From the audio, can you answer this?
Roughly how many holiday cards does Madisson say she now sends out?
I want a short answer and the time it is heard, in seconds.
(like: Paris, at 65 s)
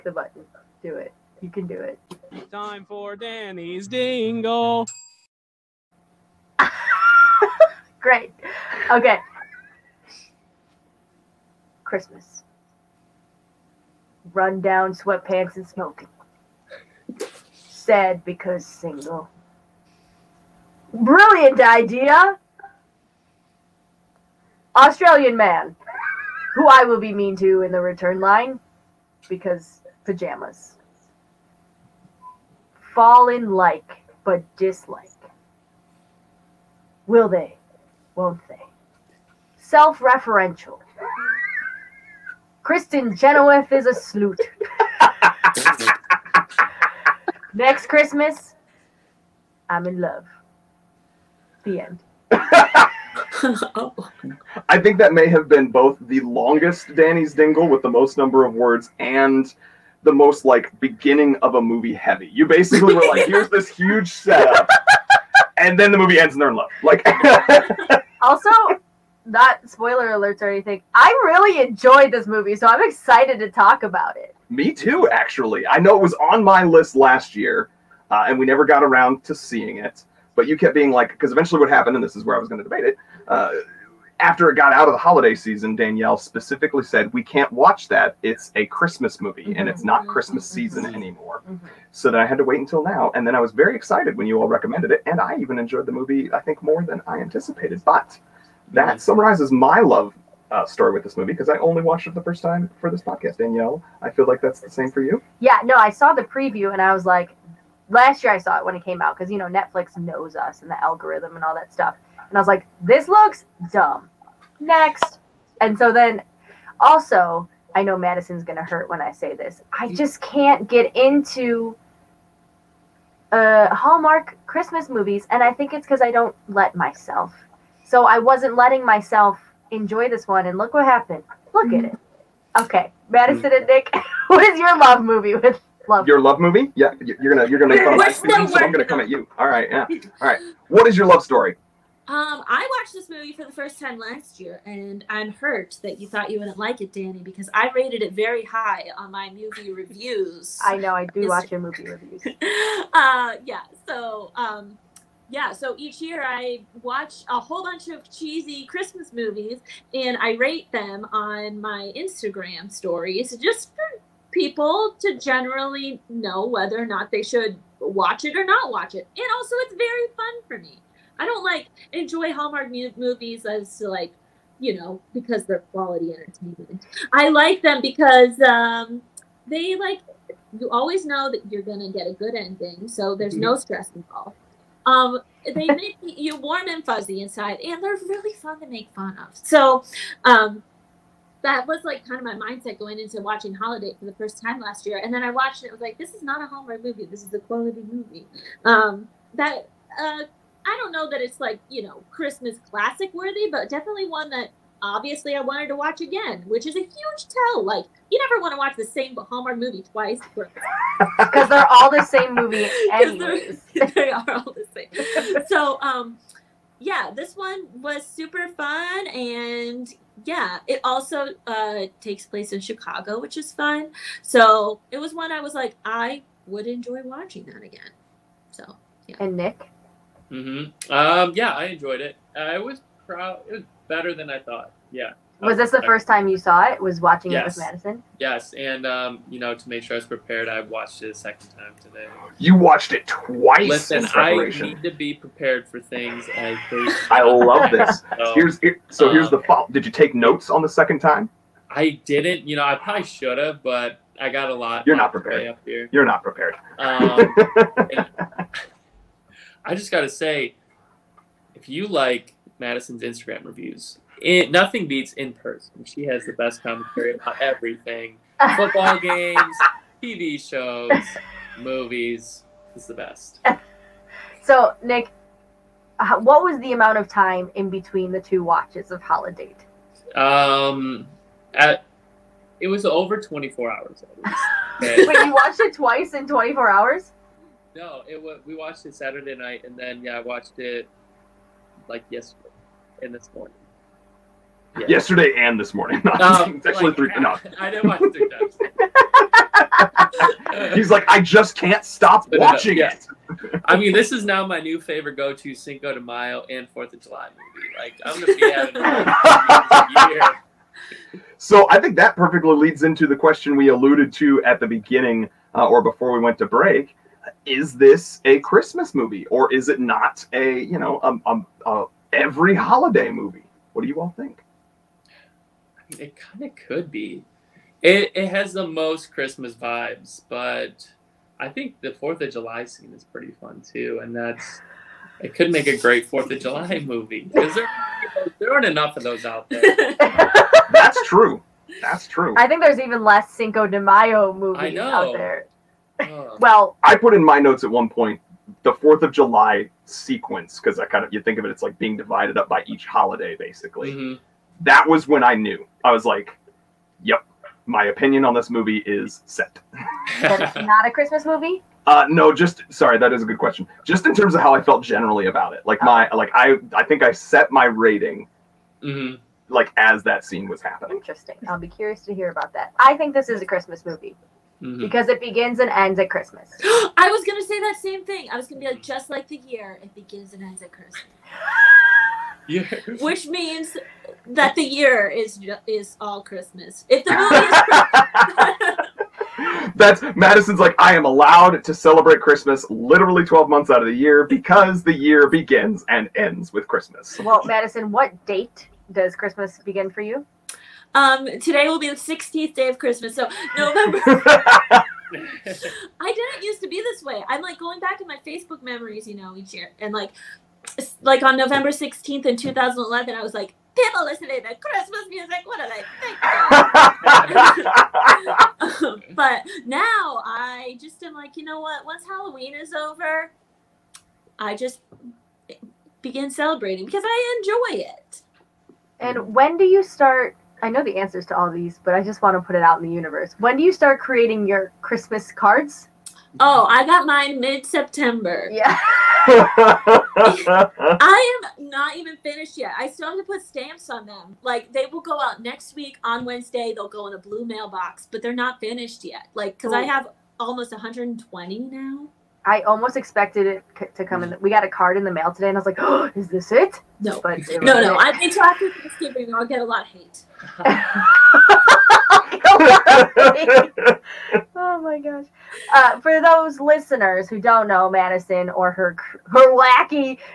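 120, at 450 s.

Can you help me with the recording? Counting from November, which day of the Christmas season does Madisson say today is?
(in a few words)
16th.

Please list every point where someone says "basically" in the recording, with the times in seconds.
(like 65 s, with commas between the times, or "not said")
62 s, 353 s.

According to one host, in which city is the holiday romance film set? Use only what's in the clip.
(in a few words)
Chicago.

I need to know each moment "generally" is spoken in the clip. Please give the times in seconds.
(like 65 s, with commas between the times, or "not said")
165 s, 364 s.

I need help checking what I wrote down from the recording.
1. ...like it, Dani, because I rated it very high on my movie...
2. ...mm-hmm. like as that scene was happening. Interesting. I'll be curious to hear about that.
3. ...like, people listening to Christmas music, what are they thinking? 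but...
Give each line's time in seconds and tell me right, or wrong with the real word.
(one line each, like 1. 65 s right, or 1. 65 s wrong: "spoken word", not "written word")
1. 146 s right
2. 368 s right
3. 413 s right.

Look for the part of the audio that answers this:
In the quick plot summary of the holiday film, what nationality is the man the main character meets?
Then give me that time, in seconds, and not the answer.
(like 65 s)
24 s.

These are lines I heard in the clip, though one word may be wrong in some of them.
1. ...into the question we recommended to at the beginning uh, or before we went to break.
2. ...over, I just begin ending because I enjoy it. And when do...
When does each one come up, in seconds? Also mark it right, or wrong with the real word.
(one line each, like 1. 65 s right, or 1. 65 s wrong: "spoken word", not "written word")
1. 312 s wrong: "alluded", not "recommended"
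2. 422 s wrong: "celebrating", not "ending".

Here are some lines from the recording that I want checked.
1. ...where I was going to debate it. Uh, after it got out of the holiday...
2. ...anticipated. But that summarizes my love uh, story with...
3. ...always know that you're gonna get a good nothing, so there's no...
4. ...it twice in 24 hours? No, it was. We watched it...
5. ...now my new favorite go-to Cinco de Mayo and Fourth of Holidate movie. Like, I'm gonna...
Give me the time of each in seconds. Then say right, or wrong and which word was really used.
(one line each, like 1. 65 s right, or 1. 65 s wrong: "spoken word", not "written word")
1. 82 s right
2. 97 s right
3. 180 s wrong: "ending", not "nothing"
4. 285 s right
5. 304 s wrong: "July", not "Holidate".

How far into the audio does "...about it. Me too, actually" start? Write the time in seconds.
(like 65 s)
73 s.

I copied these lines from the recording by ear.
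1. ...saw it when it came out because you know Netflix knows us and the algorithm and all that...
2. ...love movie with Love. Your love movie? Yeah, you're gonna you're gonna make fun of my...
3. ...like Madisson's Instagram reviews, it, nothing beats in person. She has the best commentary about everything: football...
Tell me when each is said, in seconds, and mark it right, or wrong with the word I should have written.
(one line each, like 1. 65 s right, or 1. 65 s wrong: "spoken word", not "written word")
1. 108 s right
2. 134 s right
3. 261 s right.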